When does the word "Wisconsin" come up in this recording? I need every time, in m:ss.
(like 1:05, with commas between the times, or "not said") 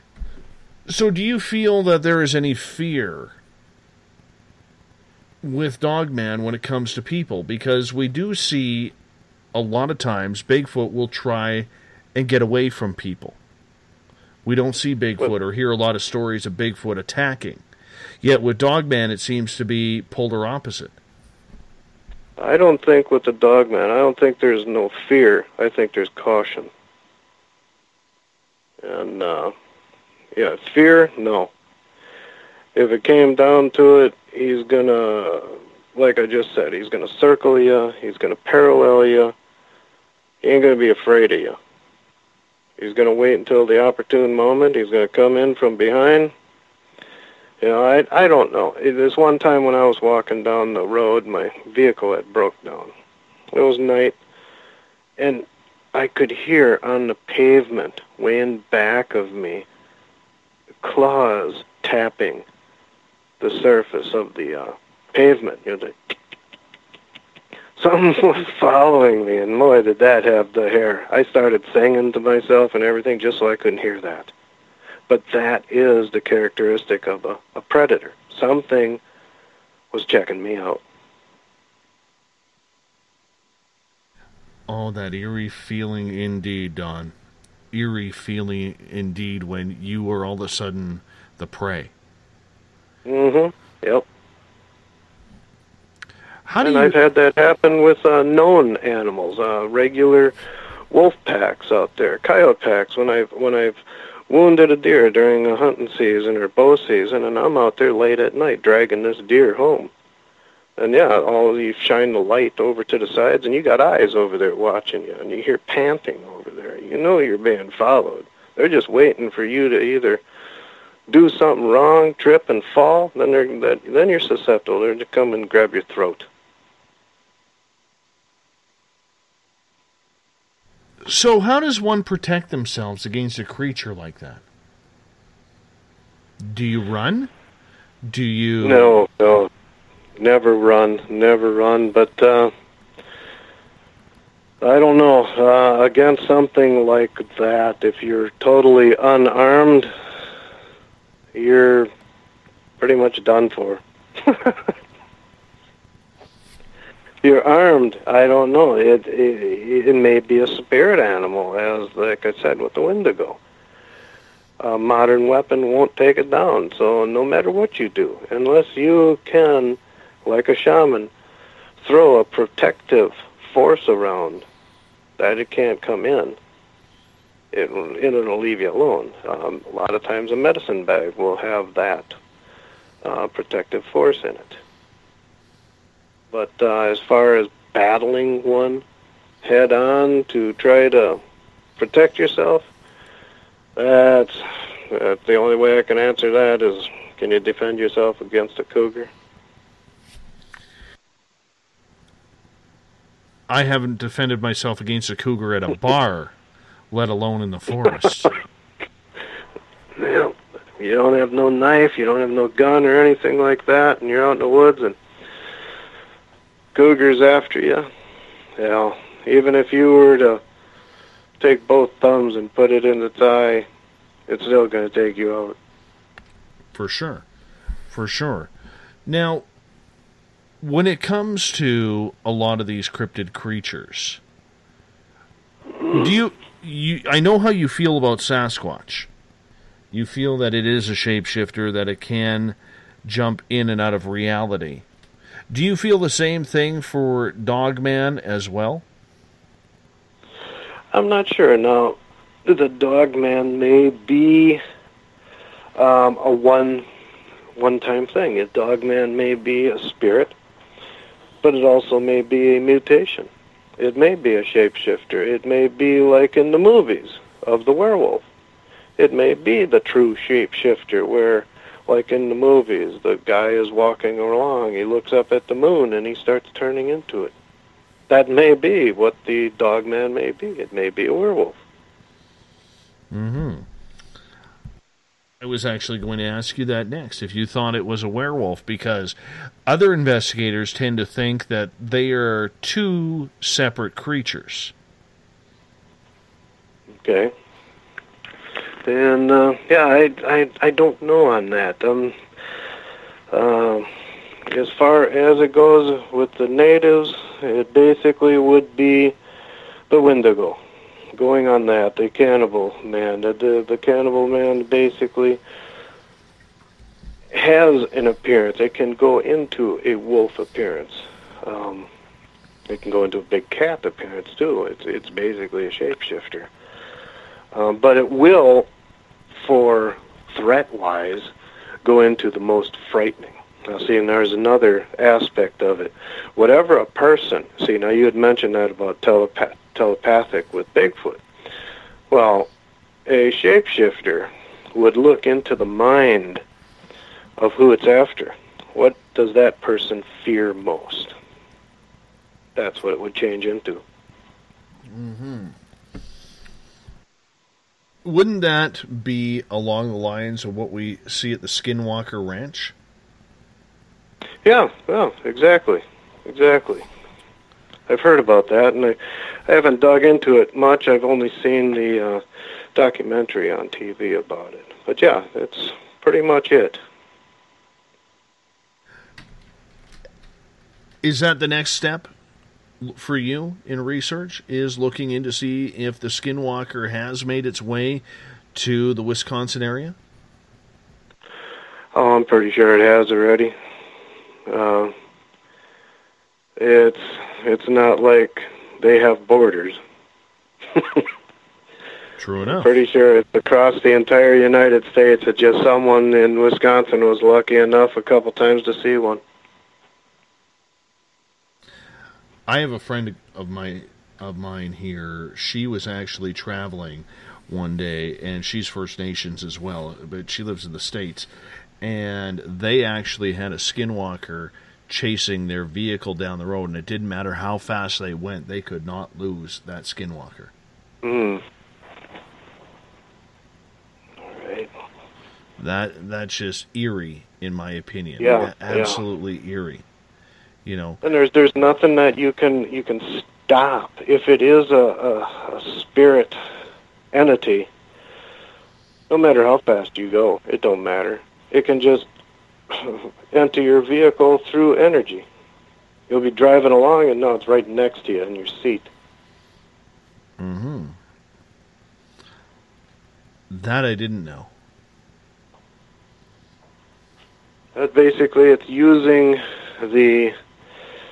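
6:29, 6:46.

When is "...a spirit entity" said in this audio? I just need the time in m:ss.
7:25.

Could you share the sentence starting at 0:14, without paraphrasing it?
We don't see Bigfoot or hear a lot of stories of Bigfoot attacking.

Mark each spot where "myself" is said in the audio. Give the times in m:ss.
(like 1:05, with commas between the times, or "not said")
1:12, 3:24.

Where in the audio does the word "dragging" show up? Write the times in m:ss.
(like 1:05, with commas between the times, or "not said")
1:48.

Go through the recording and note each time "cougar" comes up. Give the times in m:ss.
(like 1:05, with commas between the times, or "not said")
3:18, 3:25, 3:36.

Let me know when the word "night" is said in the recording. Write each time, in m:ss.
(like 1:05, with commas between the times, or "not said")
0:53, 1:48.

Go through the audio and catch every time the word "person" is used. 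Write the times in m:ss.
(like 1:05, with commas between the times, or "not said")
5:36, 5:49.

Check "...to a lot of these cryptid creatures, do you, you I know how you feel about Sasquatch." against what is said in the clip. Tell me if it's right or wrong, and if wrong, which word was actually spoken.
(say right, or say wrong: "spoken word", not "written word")
right.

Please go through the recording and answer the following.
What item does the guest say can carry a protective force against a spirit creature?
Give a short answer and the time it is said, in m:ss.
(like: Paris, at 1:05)
Medicine bag, at 3:00.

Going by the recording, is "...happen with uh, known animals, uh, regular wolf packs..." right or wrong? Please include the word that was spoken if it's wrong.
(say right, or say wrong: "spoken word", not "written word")
right.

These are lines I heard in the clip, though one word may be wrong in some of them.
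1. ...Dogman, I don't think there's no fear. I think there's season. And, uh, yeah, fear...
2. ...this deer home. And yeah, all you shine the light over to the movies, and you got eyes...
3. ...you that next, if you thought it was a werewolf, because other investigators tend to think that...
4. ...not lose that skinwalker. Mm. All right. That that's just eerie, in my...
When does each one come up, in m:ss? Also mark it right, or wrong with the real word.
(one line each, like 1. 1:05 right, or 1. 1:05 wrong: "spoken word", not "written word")
1. 0:23 wrong: "caution", not "season"
2. 1:49 wrong: "sides", not "movies"
3. 4:46 right
4. 7:08 right.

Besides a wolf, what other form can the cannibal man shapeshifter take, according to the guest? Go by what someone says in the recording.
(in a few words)
Big cat.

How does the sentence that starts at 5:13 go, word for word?
The, the, the cannibal man basically has an appearance.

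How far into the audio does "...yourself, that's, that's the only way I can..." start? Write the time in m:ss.
3:12.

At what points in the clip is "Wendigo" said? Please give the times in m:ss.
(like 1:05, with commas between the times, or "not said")
2:42, 5:10.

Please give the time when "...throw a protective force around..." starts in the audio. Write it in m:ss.
2:51.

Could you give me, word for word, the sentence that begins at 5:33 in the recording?
Now, see, and there's another aspect of it.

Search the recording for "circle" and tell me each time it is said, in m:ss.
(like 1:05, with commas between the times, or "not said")
0:37.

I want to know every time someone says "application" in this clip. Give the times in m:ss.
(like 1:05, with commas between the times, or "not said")
not said.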